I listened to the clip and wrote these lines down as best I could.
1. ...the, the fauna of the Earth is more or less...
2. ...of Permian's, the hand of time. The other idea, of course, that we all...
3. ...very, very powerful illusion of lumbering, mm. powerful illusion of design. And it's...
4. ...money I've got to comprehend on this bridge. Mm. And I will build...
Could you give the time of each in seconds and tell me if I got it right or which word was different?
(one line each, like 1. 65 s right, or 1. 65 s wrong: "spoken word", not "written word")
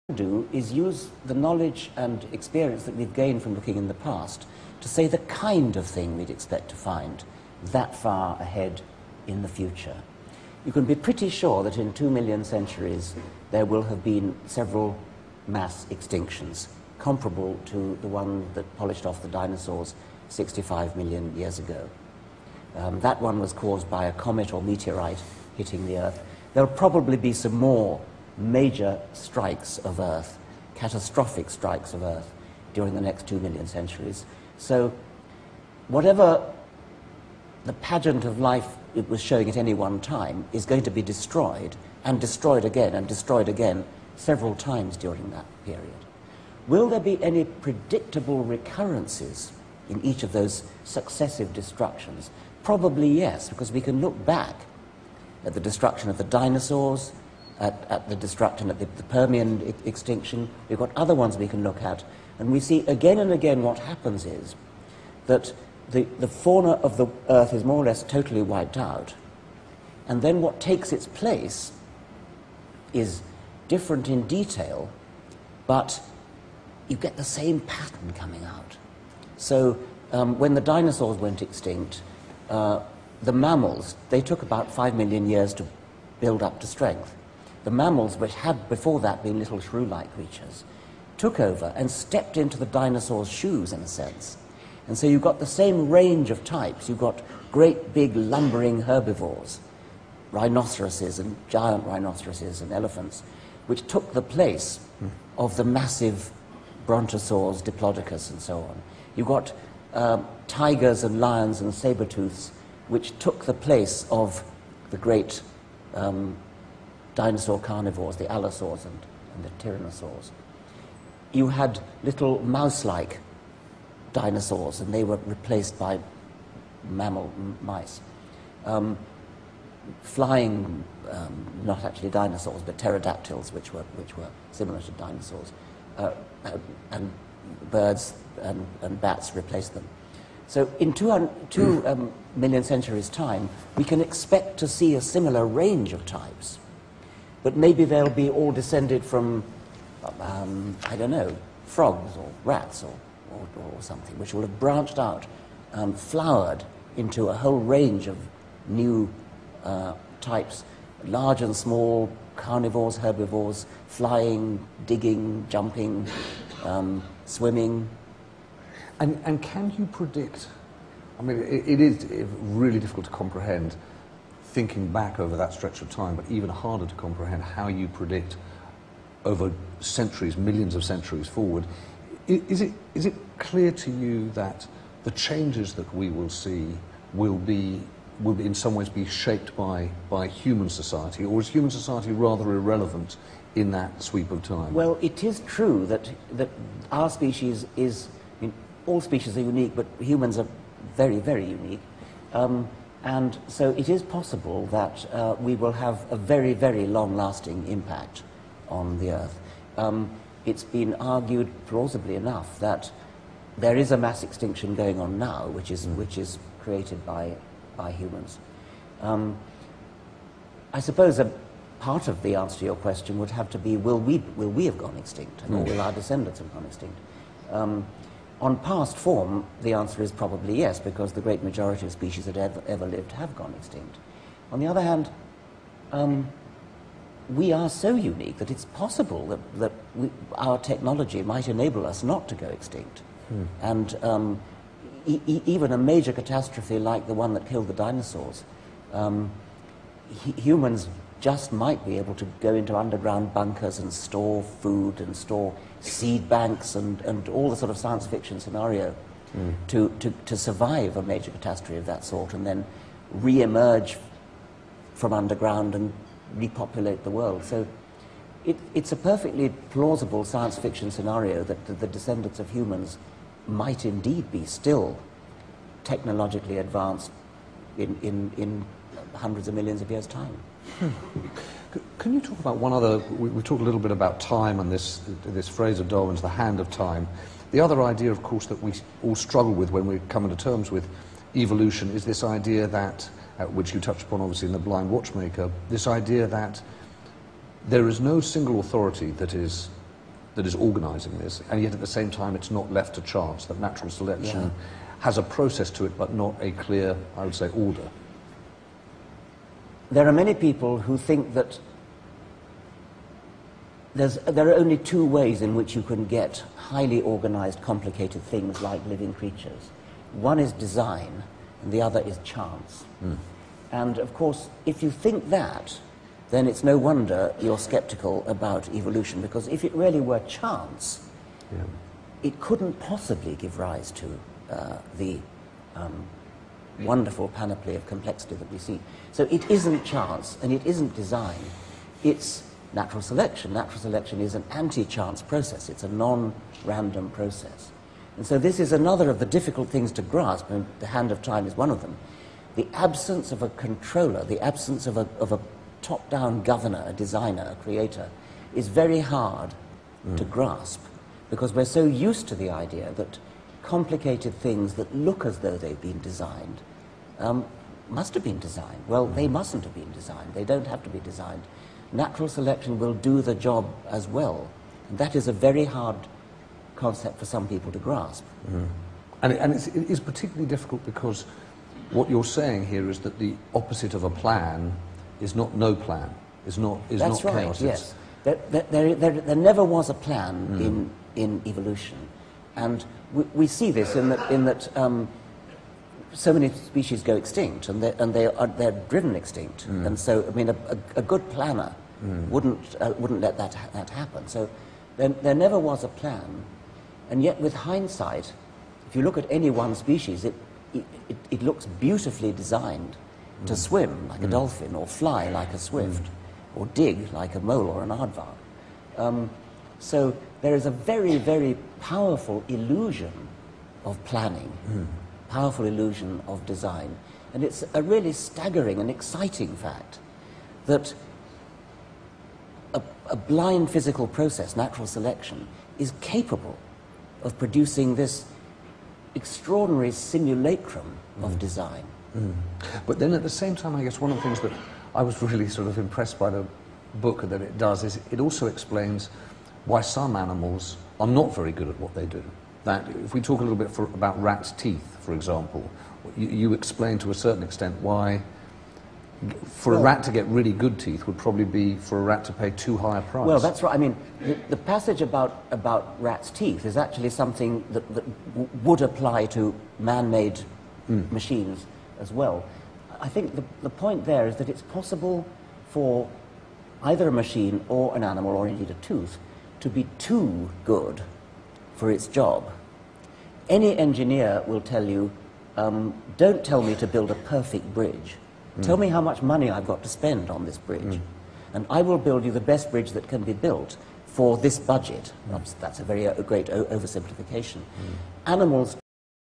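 1. 65 s right
2. 285 s wrong: "Darwin", not "Permian"
3. 420 s wrong: "planning", not "lumbering"
4. 489 s wrong: "spend", not "comprehend".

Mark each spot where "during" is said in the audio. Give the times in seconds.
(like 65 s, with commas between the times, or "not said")
32 s, 44 s.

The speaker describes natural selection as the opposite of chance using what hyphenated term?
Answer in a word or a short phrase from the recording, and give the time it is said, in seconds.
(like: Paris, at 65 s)
anti-chance process, at 344 s.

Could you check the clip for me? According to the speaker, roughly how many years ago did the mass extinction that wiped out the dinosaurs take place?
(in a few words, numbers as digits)
65 million years ago.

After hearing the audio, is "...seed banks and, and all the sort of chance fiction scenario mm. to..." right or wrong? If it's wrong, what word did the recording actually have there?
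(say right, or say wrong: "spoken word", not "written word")
wrong: "science", not "chance".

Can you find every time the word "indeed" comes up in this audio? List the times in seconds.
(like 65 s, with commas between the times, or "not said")
273 s, 478 s.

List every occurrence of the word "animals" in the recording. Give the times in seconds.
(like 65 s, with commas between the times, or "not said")
450 s, 478 s, 498 s.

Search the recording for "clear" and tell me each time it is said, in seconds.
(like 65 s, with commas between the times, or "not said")
183 s, 306 s.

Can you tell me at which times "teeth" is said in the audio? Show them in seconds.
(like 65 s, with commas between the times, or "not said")
454 s, 460 s, 466 s.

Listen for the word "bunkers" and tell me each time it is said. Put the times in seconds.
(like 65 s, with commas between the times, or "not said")
253 s.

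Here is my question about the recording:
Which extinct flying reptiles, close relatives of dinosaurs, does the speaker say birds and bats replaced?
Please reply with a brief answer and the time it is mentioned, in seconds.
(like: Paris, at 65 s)
pterodactyls, at 132 s.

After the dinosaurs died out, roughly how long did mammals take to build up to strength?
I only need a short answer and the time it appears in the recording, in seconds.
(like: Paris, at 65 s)
about 5 million years, at 84 s.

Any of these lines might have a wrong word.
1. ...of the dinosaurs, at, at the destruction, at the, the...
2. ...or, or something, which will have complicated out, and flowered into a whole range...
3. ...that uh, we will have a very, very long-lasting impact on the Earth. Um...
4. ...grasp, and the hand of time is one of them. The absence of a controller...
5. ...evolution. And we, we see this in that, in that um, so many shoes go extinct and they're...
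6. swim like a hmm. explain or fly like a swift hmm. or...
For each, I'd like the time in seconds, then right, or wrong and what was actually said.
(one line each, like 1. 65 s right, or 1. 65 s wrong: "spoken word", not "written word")
1. 56 s right
2. 153 s wrong: "branched", not "complicated"
3. 204 s right
4. 350 s right
5. 391 s wrong: "species", not "shoes"
6. 413 s wrong: "dolphin", not "explain".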